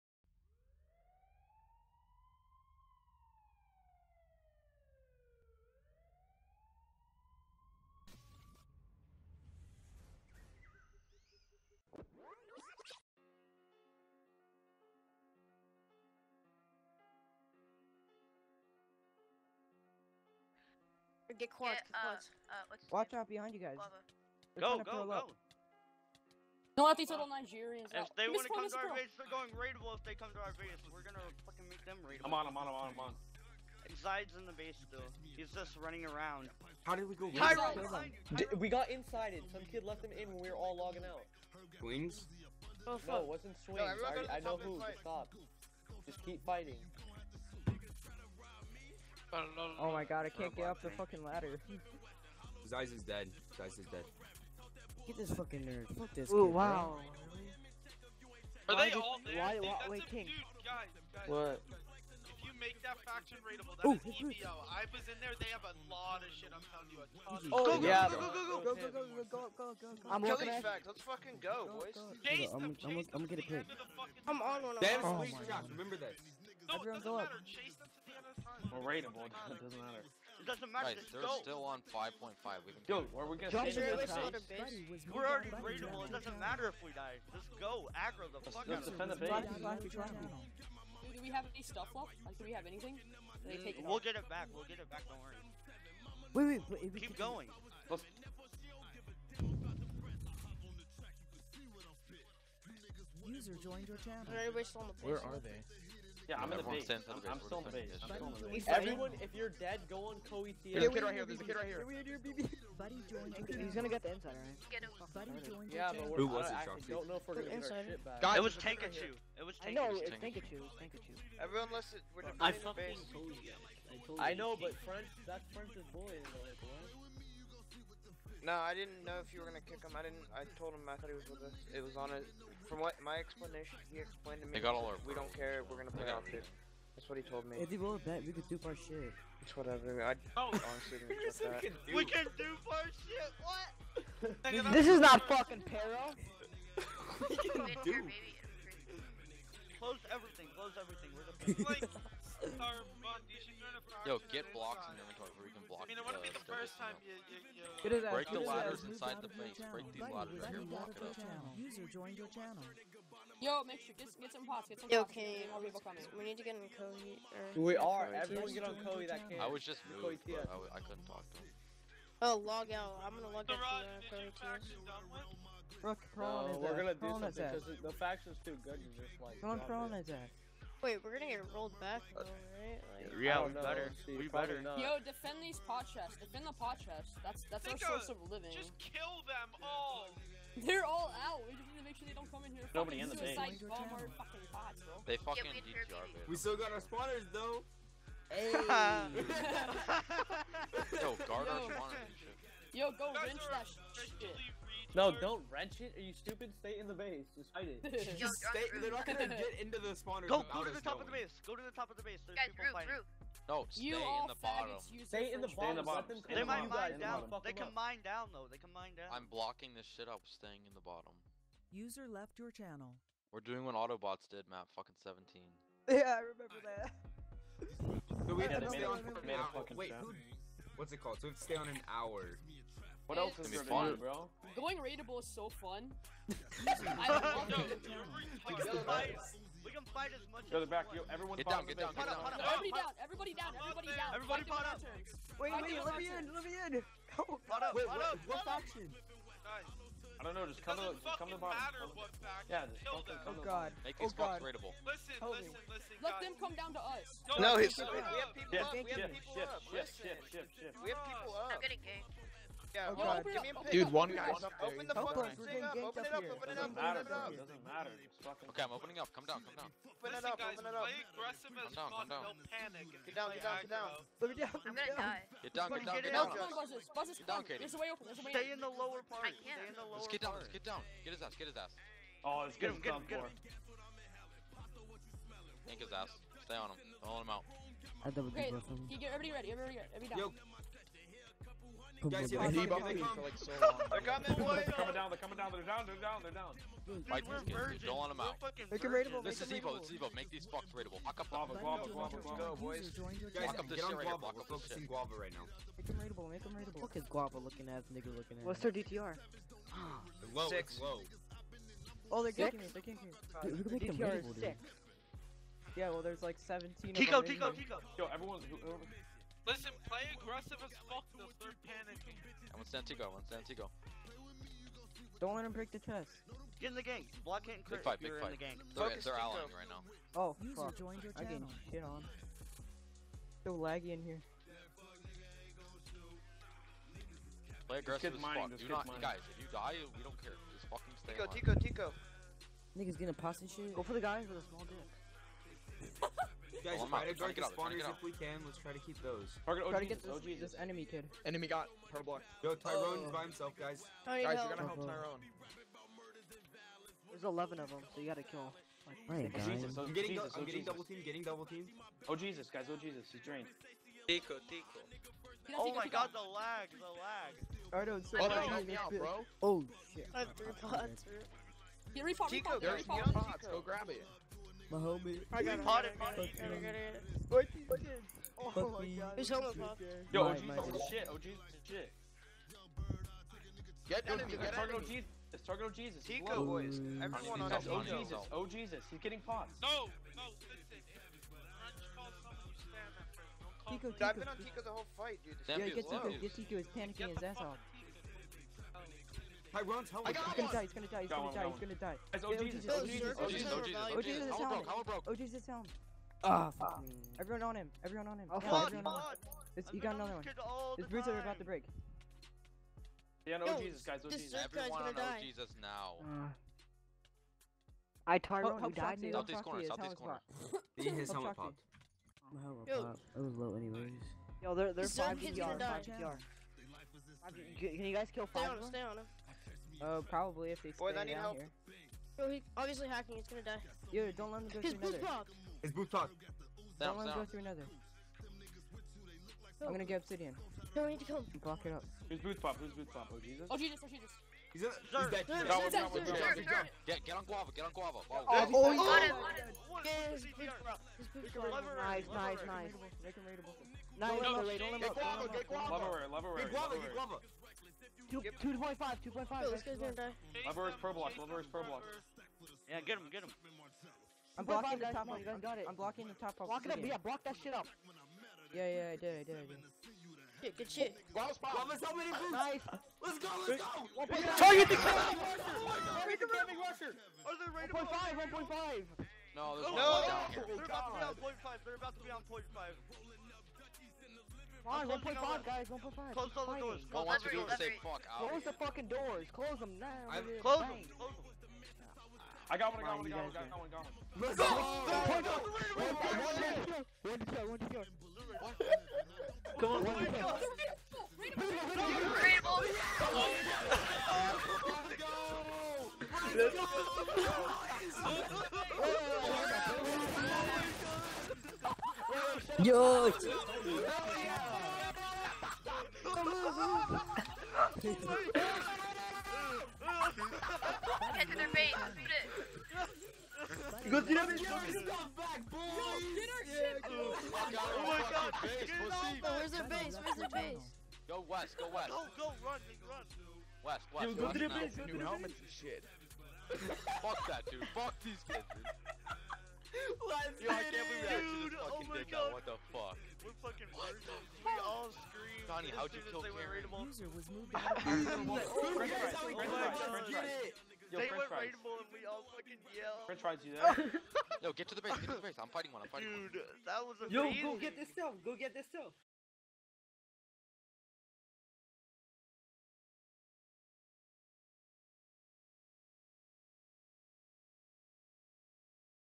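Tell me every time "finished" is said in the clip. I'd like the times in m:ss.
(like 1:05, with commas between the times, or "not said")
not said.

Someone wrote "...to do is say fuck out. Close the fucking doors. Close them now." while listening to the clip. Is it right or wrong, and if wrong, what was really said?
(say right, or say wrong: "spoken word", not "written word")
right.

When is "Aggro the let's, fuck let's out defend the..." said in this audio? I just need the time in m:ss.
1:27.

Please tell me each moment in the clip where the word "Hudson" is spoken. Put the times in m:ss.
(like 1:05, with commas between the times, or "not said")
not said.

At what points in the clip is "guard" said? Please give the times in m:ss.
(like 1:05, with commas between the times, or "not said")
3:21, 5:47.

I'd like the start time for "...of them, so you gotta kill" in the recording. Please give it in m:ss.
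5:57.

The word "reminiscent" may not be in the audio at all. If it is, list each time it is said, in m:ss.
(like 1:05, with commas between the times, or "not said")
not said.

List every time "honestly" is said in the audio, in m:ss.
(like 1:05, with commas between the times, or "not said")
2:20.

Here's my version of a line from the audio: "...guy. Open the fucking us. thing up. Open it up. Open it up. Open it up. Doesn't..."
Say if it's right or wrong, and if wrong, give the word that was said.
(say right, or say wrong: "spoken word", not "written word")
right.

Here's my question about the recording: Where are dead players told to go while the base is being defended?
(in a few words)
Kohi Theater.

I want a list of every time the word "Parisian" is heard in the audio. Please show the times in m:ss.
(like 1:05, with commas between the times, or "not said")
not said.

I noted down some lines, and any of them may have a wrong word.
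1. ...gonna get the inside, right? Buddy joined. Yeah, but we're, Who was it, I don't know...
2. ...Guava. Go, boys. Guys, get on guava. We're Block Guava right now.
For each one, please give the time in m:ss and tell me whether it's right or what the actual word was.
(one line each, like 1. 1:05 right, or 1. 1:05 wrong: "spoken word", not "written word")
1. 1:53 right
2. 5:02 right.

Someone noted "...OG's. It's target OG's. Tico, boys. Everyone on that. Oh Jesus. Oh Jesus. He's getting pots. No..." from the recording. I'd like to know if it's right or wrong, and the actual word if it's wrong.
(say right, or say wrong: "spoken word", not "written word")
right.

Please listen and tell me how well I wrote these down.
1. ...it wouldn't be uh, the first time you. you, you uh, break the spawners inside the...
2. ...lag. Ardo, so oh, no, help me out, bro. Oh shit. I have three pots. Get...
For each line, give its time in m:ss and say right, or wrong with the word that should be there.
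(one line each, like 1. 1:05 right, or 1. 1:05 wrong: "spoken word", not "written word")
1. 2:36 wrong: "ladders", not "spawners"
2. 6:07 right.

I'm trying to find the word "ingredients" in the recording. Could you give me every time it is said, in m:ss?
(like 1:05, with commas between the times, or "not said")
not said.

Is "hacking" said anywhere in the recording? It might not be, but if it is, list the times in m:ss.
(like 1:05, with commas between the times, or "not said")
7:12.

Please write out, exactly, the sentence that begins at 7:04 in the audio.
Yo, they're they're five PR, five PR.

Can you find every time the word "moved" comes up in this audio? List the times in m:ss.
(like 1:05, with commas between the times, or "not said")
2:49, 9:07.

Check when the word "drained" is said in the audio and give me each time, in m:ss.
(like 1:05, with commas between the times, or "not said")
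6:03.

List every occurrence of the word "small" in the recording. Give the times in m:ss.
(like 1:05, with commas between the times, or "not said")
5:44.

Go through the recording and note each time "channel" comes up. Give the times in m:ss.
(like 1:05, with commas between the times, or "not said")
1:43, 2:42, 3:42.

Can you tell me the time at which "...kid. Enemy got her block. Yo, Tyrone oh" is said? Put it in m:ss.
5:50.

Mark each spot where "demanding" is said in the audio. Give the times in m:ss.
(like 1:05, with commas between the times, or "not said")
not said.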